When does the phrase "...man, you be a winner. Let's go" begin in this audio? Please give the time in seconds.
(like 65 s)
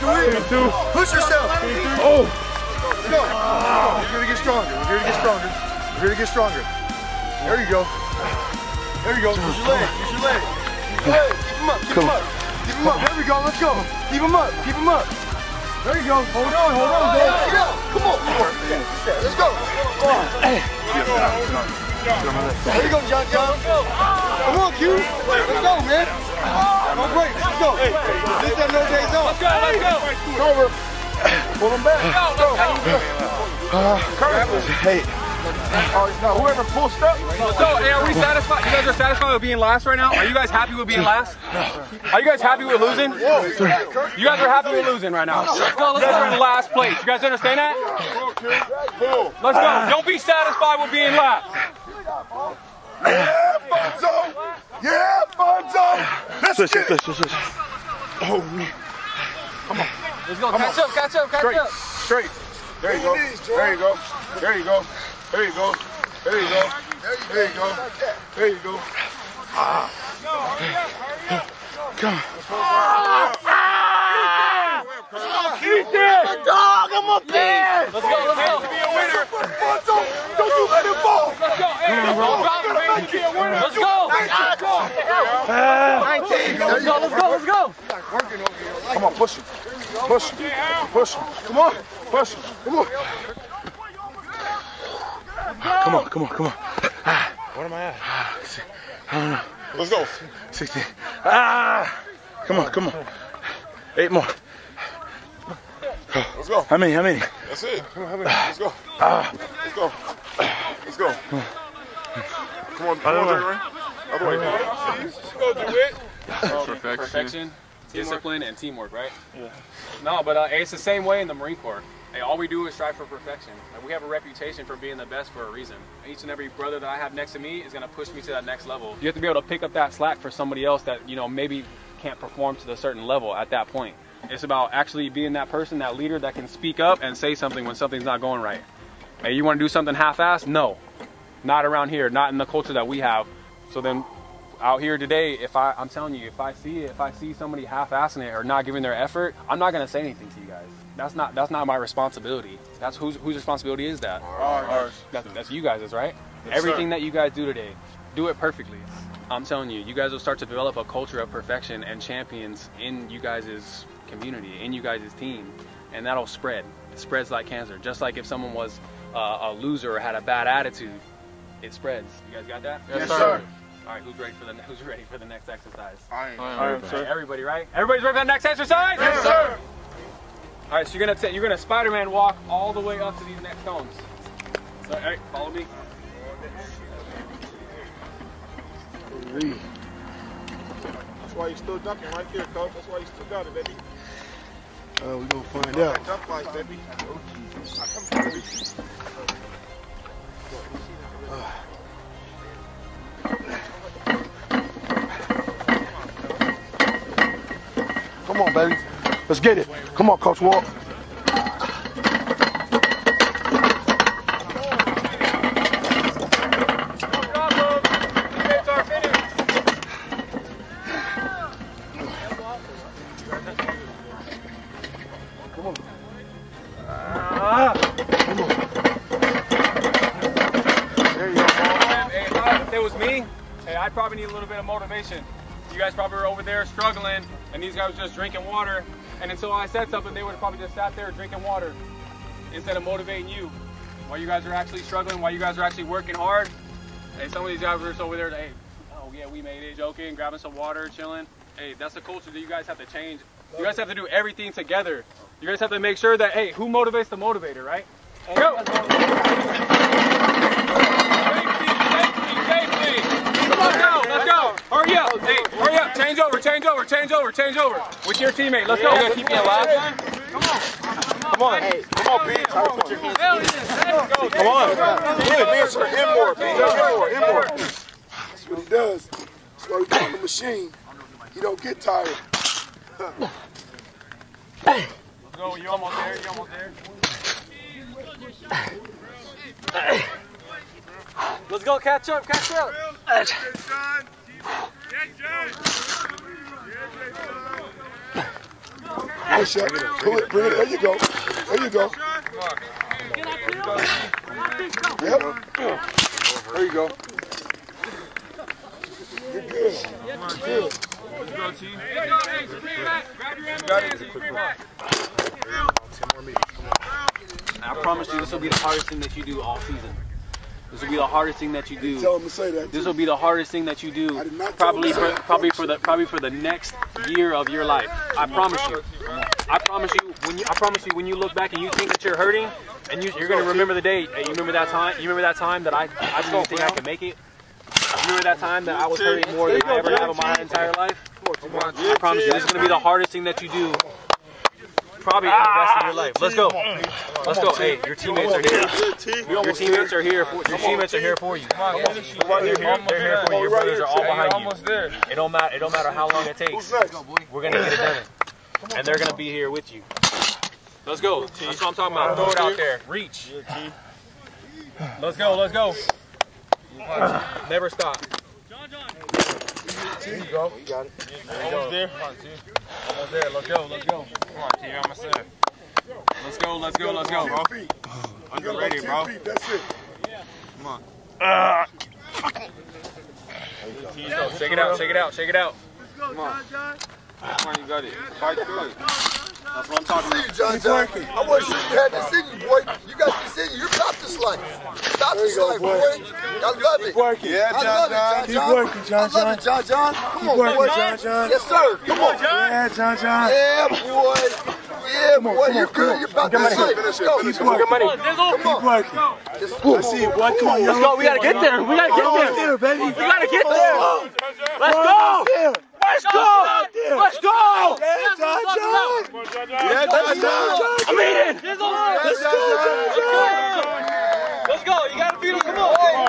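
82 s.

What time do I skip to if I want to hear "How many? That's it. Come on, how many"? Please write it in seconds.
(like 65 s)
106 s.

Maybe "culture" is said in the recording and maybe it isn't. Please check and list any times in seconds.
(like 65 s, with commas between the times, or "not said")
142 s, 160 s, 252 s.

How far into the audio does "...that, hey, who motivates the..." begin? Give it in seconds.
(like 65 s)
256 s.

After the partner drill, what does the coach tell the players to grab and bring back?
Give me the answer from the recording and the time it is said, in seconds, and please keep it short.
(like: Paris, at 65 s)
ambulance, at 313 s.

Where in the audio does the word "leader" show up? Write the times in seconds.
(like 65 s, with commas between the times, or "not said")
135 s.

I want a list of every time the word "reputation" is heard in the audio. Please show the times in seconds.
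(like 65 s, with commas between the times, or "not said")
124 s.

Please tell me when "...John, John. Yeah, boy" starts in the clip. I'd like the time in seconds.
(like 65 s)
402 s.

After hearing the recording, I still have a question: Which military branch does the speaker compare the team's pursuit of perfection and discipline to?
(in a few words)
Marine Corps.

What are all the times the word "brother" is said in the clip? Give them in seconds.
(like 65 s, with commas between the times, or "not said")
126 s, 353 s.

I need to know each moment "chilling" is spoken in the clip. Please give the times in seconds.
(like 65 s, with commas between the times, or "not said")
250 s.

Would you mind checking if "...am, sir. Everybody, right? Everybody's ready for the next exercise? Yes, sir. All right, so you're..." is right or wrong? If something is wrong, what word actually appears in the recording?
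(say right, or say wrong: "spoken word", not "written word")
right.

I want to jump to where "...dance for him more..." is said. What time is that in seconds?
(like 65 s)
275 s.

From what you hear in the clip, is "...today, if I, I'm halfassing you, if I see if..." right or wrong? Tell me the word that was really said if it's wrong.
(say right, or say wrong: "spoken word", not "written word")
wrong: "telling", not "halfassing".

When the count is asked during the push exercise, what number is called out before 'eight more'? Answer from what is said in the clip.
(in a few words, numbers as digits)
60.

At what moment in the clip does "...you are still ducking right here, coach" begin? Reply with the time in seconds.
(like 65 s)
191 s.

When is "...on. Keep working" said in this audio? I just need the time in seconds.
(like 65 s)
407 s.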